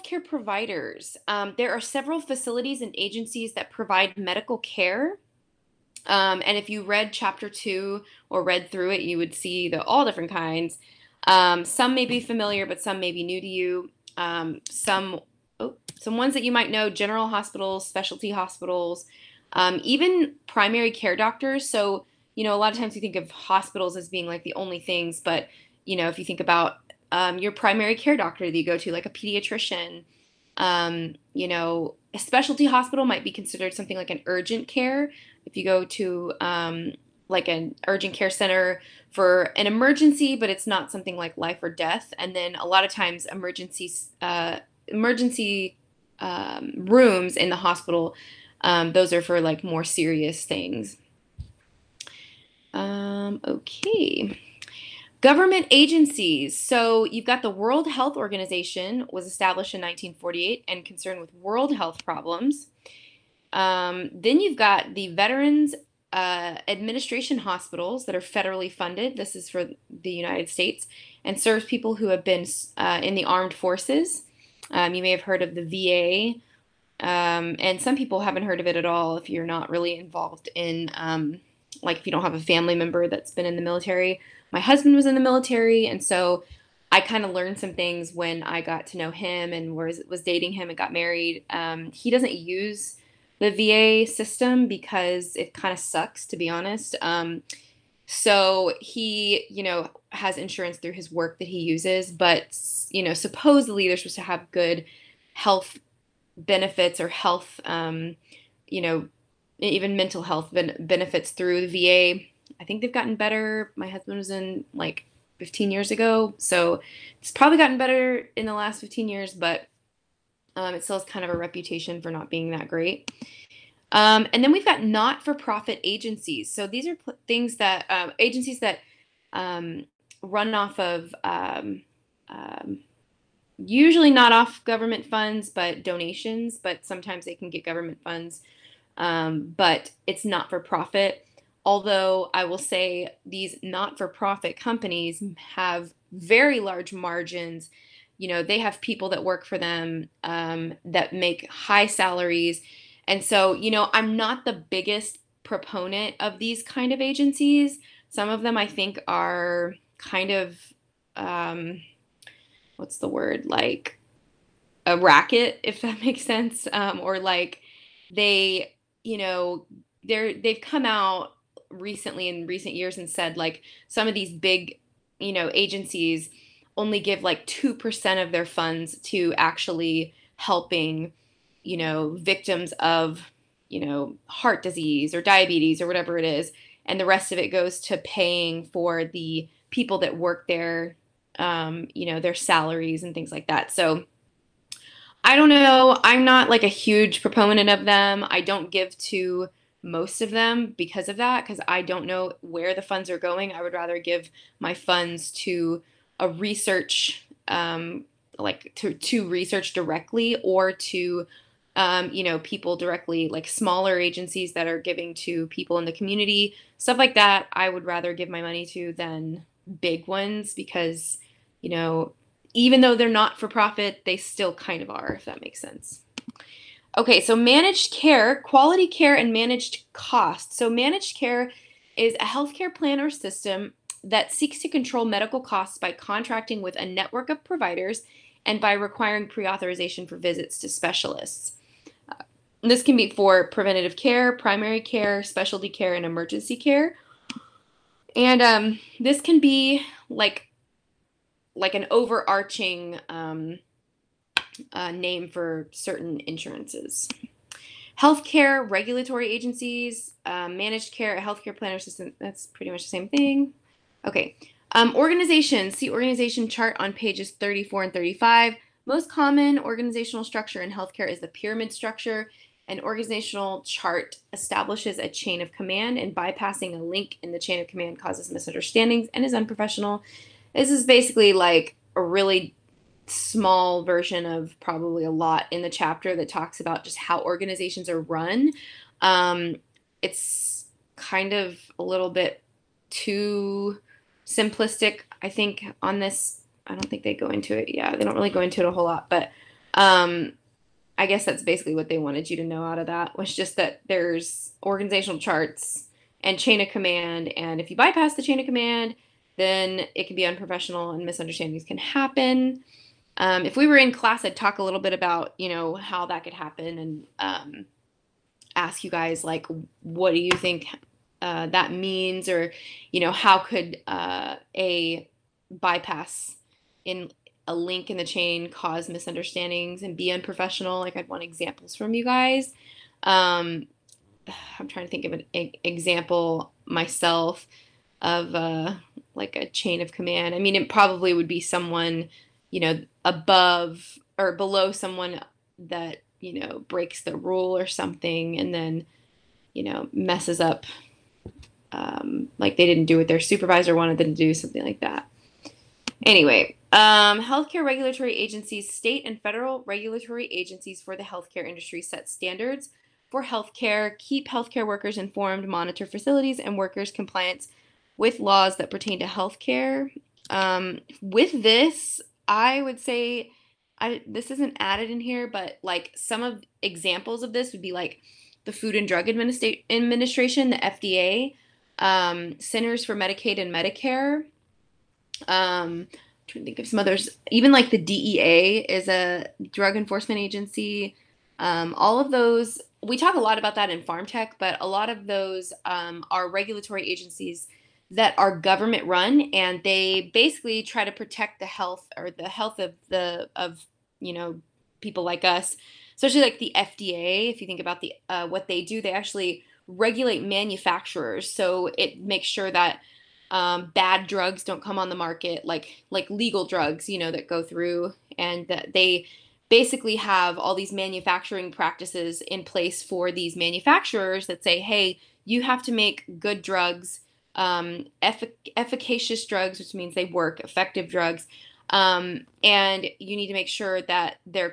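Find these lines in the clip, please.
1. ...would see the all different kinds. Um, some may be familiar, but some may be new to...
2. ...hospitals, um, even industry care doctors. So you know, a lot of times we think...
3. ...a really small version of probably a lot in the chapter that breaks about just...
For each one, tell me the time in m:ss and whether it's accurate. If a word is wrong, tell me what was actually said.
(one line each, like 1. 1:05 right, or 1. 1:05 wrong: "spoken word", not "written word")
1. 0:09 right
2. 0:18 wrong: "primary", not "industry"
3. 4:41 wrong: "talks", not "breaks".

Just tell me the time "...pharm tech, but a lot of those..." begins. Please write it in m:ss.
6:33.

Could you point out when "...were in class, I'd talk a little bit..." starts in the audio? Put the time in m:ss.
5:13.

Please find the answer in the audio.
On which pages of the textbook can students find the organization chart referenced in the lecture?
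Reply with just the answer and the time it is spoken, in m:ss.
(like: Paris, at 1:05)
34 and 35, at 4:27.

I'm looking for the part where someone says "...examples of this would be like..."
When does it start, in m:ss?
6:16.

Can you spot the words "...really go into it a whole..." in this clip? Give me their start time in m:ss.
4:58.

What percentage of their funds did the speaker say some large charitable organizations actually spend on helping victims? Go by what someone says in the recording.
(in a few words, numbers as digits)
2%.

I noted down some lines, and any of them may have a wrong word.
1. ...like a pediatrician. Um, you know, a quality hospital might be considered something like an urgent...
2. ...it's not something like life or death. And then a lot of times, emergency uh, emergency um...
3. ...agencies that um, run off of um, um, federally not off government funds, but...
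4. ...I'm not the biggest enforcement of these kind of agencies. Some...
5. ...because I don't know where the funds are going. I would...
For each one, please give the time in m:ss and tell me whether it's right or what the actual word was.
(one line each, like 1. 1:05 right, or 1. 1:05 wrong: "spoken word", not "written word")
1. 0:28 wrong: "specialty", not "quality"
2. 0:40 right
3. 2:08 wrong: "usually", not "federally"
4. 2:33 wrong: "proponent", not "enforcement"
5. 3:21 right.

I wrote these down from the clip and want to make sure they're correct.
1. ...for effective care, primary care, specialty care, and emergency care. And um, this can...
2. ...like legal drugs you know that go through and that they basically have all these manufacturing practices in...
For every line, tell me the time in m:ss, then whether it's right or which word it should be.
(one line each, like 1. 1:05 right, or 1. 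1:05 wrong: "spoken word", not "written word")
1. 4:03 wrong: "preventative", not "effective"
2. 6:55 right.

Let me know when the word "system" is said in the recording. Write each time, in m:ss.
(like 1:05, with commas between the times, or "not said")
1:34, 3:53, 4:21.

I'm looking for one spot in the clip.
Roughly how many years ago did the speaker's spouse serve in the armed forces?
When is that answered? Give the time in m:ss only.
1:55.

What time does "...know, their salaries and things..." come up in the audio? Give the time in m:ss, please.
3:12.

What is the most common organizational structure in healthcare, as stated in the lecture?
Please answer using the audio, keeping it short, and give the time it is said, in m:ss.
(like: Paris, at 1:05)
pyramid structure, at 4:31.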